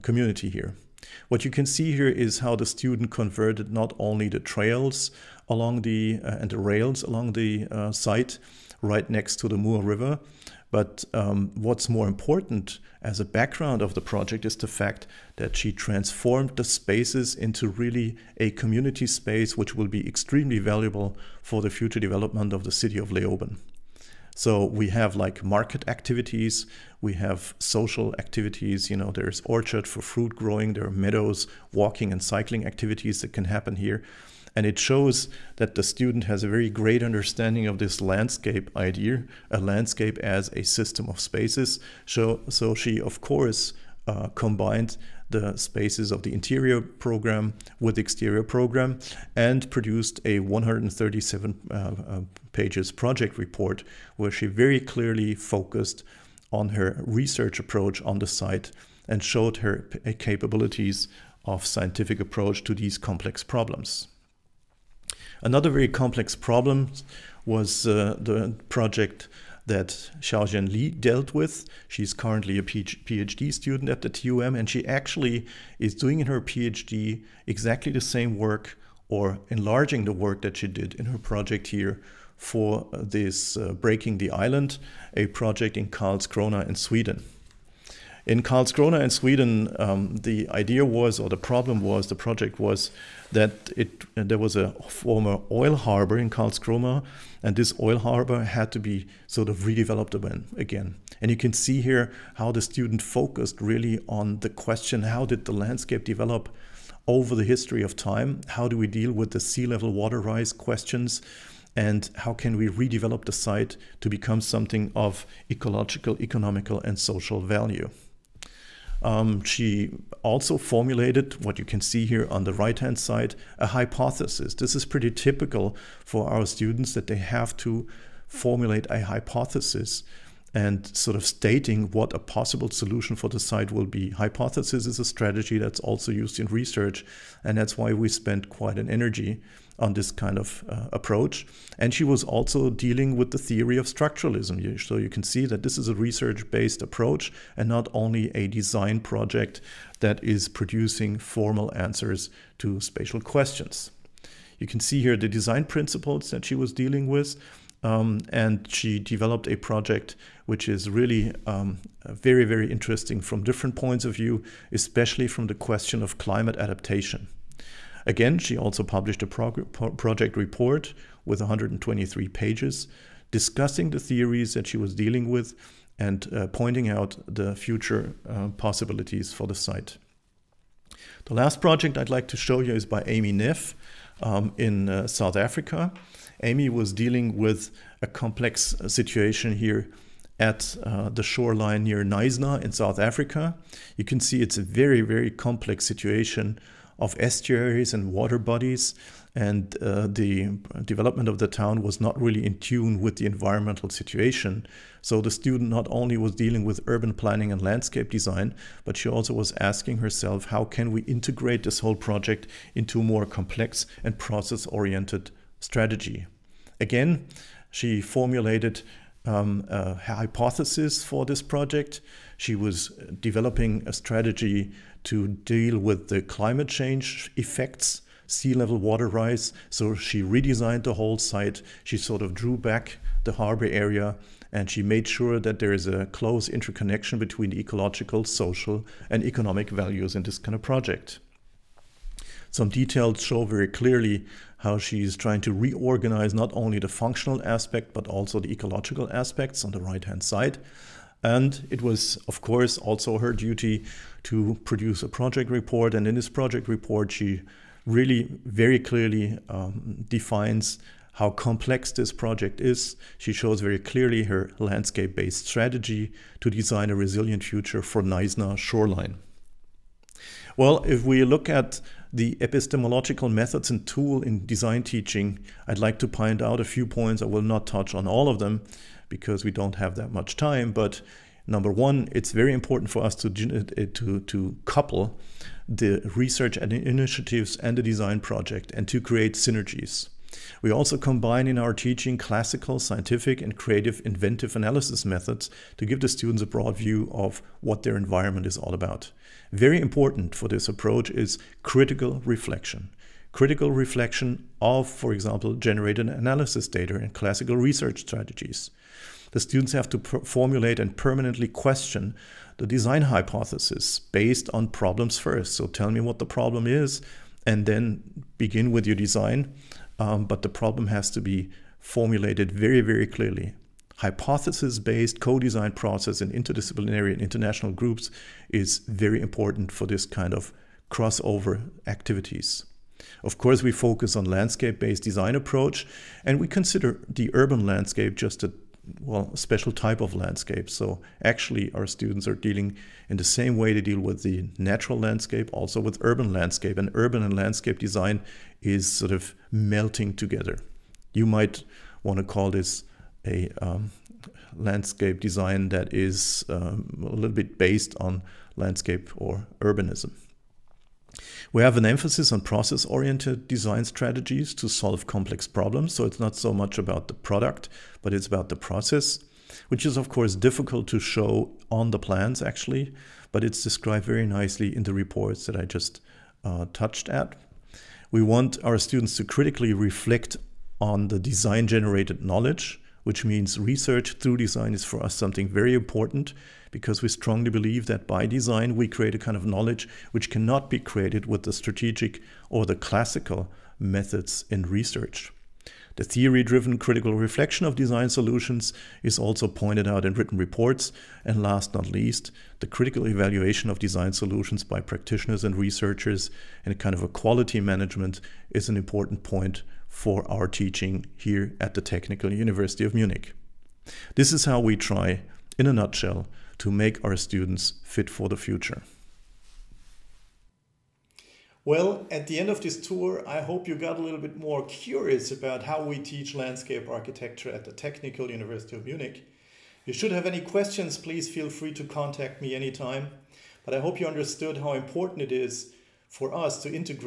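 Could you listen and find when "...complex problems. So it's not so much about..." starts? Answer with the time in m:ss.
6:05.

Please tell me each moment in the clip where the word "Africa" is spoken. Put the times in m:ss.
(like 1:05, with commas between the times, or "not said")
3:05, 3:12.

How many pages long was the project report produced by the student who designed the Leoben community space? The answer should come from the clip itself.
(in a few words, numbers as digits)
137.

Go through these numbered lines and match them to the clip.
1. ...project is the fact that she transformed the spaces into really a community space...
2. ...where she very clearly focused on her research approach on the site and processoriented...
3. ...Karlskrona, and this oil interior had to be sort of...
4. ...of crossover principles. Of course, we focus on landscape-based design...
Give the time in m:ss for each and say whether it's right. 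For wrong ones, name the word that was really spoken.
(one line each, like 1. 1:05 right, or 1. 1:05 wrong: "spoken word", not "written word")
1. 0:14 right
2. 0:54 wrong: "showed", not "processoriented"
3. 1:36 wrong: "harbor", not "interior"
4. 5:30 wrong: "activities", not "principles".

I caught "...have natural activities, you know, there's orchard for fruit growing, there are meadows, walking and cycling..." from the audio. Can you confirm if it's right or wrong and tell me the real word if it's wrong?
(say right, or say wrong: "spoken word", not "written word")
wrong: "social", not "natural".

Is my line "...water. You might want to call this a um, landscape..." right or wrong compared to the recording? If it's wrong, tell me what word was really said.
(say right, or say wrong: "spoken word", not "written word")
wrong: "together", not "water".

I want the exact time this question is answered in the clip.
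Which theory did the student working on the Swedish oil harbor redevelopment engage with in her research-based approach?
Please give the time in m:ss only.
2:23.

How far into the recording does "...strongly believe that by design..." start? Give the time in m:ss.
6:27.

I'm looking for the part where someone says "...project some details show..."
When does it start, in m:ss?
4:00.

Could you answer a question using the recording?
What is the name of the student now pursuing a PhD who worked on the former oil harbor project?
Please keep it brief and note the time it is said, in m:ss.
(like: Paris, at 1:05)
Xiaojian Li, at 1:10.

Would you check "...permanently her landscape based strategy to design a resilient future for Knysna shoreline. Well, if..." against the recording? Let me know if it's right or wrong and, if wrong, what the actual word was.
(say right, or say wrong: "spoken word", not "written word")
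wrong: "clearly", not "permanently".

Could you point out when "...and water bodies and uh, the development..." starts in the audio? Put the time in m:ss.
3:17.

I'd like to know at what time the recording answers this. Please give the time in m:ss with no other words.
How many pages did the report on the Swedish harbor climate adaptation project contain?
2:51.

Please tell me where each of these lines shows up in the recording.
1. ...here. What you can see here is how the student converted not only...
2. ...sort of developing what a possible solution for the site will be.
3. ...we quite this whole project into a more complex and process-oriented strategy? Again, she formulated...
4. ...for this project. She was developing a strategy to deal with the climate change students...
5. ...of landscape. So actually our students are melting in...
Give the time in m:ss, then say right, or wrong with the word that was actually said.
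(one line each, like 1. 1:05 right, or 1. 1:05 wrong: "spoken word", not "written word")
1. 0:00 right
2. 2:10 wrong: "stating", not "developing"
3. 3:30 wrong: "integrate", not "quite"
4. 3:41 wrong: "effects", not "students"
5. 5:40 wrong: "dealing", not "melting".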